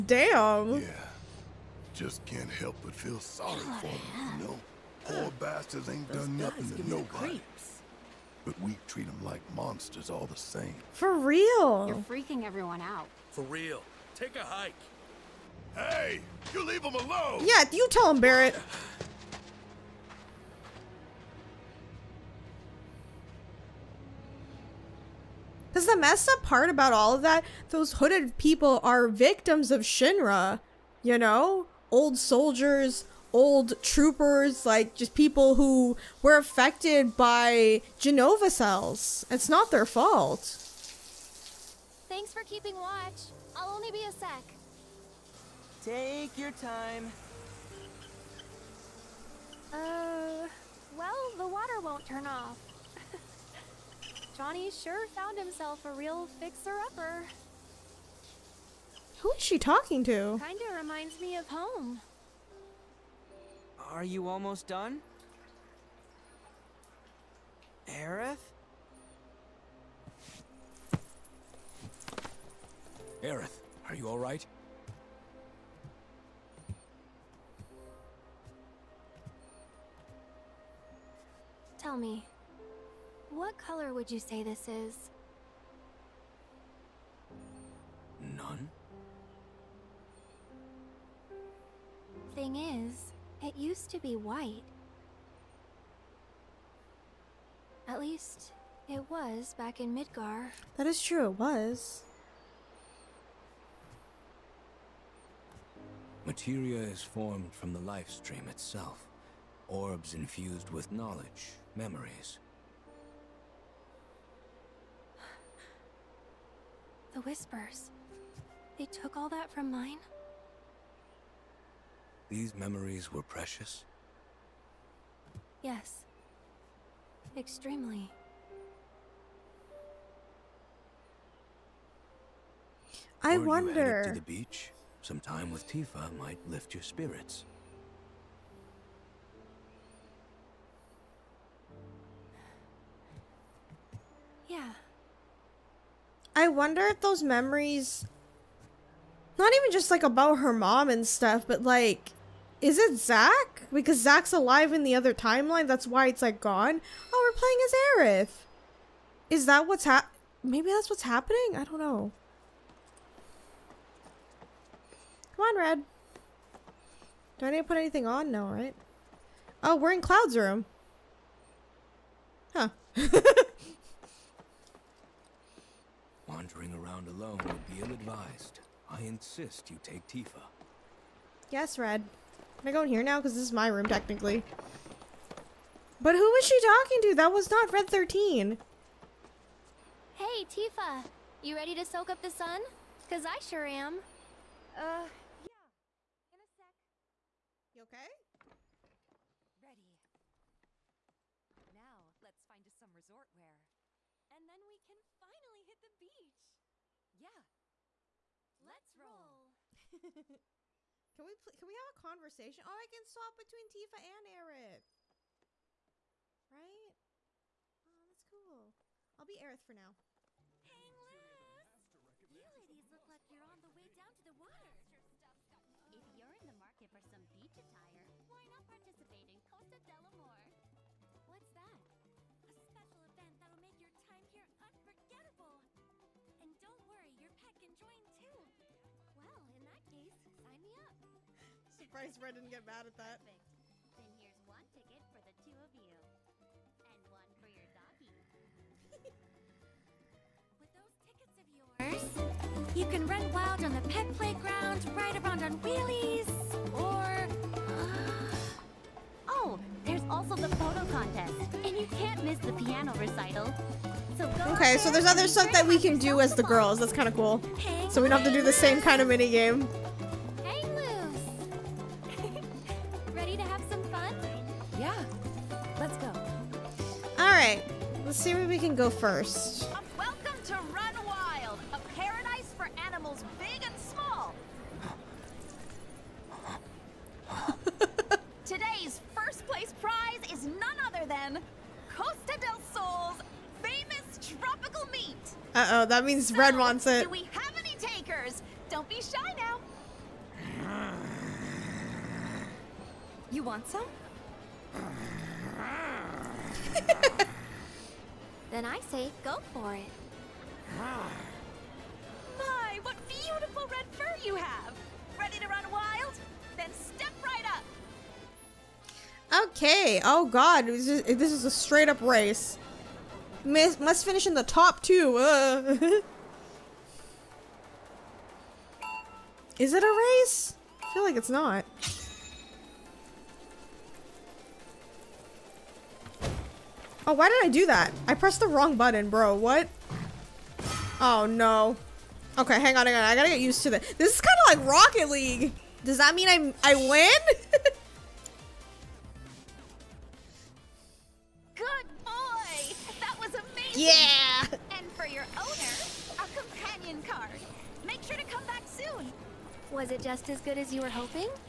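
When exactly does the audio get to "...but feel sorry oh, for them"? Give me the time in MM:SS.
00:02.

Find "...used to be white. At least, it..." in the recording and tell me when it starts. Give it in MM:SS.
01:33.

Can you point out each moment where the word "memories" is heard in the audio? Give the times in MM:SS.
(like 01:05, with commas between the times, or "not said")
01:51, 02:02, 02:27.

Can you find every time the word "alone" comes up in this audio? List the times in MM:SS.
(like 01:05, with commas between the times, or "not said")
00:16, 02:57.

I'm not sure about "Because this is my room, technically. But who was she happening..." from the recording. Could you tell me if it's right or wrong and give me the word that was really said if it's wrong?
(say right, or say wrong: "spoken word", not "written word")
wrong: "talking", not "happening".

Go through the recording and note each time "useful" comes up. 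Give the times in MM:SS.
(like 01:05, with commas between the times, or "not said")
not said.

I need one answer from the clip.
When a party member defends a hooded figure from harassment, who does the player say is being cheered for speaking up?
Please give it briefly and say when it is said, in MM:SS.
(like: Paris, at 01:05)
Barret, at 00:18.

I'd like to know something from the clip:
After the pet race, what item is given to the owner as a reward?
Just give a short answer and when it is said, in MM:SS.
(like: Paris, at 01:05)
companion card, at 05:56.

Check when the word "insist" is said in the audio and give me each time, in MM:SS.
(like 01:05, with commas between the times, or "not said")
02:59.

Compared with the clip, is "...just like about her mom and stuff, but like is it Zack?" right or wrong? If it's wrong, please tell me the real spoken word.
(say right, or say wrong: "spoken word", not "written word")
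right.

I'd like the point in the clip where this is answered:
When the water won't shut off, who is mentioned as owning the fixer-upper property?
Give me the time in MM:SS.
00:54.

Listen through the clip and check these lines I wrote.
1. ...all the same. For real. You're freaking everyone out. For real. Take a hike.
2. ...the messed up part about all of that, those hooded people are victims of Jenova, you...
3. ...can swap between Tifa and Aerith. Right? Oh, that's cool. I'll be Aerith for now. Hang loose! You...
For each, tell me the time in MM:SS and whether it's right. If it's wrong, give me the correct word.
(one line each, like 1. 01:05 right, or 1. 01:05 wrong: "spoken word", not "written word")
1. 00:10 right
2. 00:25 wrong: "Shinra", not "Jenova"
3. 03:32 right.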